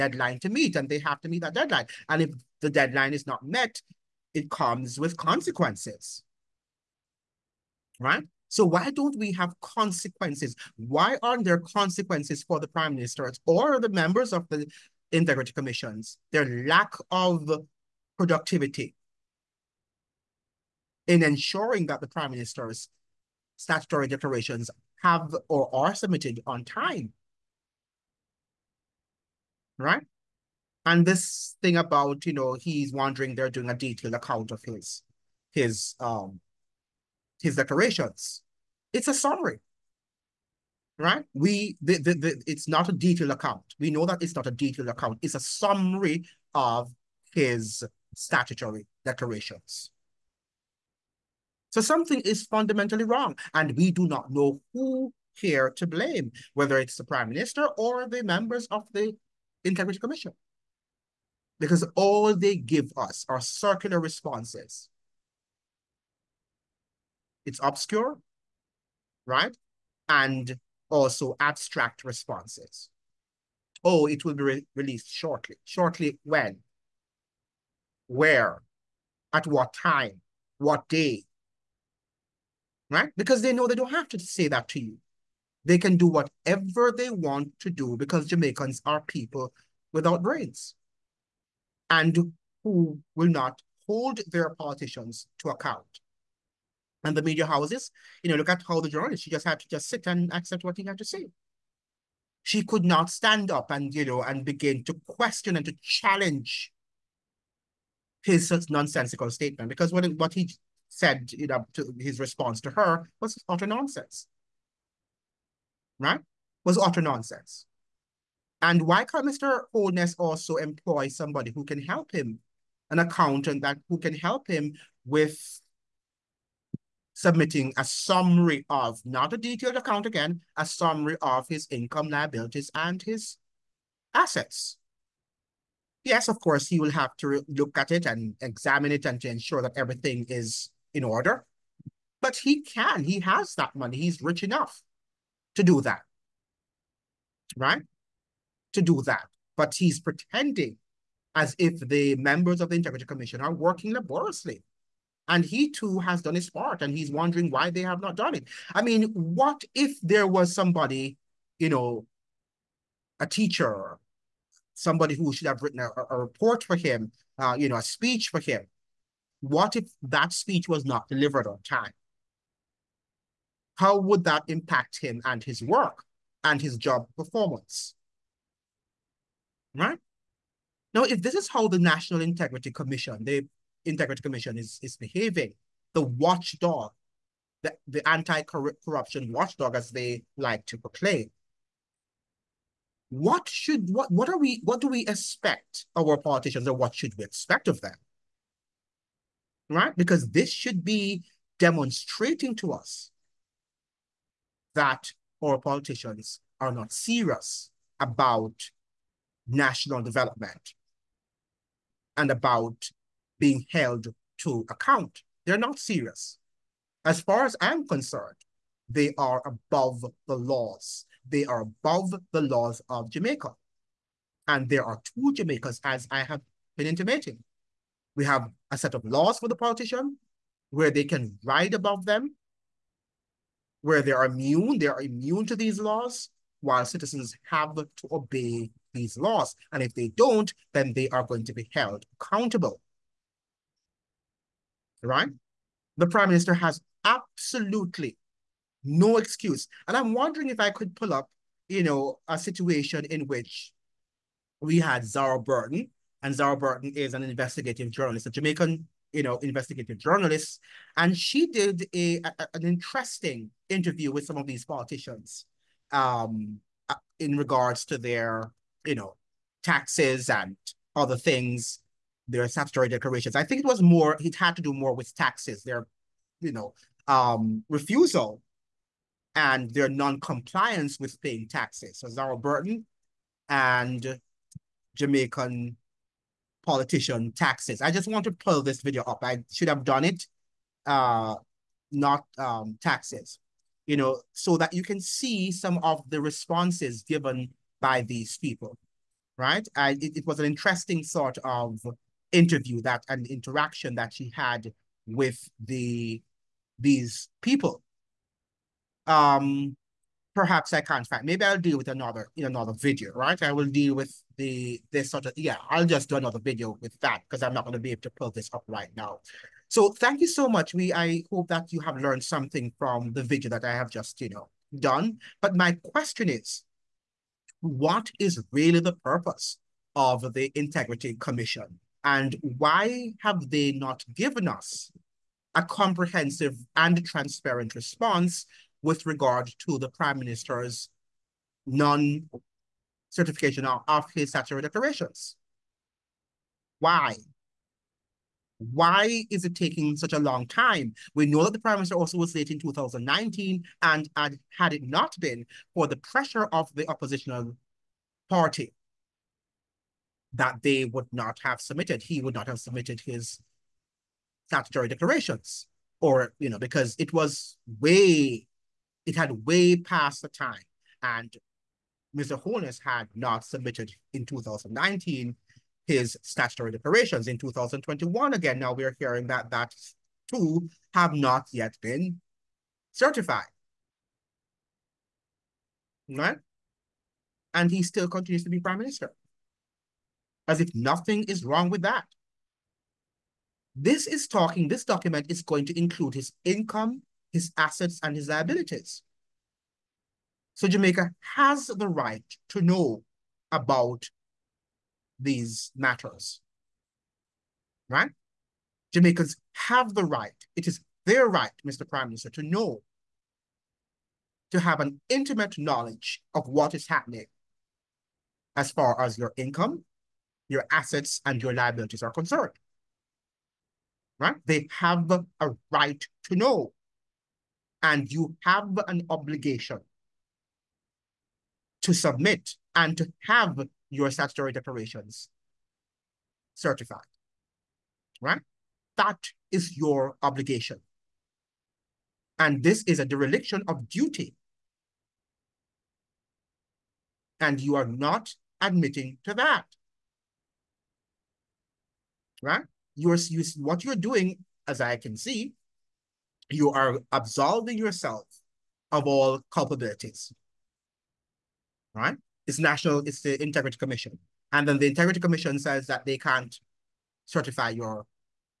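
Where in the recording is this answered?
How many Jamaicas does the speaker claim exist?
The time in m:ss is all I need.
3:45.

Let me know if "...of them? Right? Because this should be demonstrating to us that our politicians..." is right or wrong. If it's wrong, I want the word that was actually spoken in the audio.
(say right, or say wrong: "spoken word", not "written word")
right.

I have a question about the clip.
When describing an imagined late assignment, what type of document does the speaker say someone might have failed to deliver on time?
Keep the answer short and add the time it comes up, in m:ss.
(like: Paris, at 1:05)
A speech, at 2:47.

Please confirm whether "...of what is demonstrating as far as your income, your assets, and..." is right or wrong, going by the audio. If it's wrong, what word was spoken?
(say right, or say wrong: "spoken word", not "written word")
wrong: "happening", not "demonstrating".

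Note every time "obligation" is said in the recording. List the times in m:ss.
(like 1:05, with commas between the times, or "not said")
7:09, 7:20.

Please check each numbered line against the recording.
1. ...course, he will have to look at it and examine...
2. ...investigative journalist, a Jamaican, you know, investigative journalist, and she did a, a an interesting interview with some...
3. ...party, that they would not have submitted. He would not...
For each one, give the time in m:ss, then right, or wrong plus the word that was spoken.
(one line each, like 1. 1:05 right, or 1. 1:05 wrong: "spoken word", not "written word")
1. 2:16 right
2. 4:17 right
3. 5:58 right.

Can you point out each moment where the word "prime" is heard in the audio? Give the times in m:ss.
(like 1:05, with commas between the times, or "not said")
0:12, 0:22, 0:57, 4:06, 5:39, 5:51, 6:28, 6:51.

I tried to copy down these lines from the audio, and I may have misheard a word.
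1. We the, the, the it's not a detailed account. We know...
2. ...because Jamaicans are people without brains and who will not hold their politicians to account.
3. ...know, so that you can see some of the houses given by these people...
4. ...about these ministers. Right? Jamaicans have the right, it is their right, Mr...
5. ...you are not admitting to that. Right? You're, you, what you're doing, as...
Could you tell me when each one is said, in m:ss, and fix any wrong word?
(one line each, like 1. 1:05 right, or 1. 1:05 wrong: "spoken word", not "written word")
1. 0:41 right
2. 1:27 right
3. 4:53 wrong: "responses", not "houses"
4. 6:43 wrong: "matters", not "ministers"
5. 7:27 right.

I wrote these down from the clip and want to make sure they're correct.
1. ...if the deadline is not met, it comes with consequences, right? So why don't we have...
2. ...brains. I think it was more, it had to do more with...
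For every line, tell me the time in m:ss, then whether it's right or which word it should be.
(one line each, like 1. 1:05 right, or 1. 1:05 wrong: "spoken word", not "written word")
1. 0:02 right
2. 4:32 wrong: "declarations", not "brains".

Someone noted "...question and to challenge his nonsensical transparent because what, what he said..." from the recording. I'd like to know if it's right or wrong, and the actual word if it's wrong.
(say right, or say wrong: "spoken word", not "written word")
wrong: "statement", not "transparent".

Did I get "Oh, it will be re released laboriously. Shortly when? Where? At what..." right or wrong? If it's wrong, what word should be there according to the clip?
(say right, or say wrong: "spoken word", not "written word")
wrong: "shortly", not "laboriously".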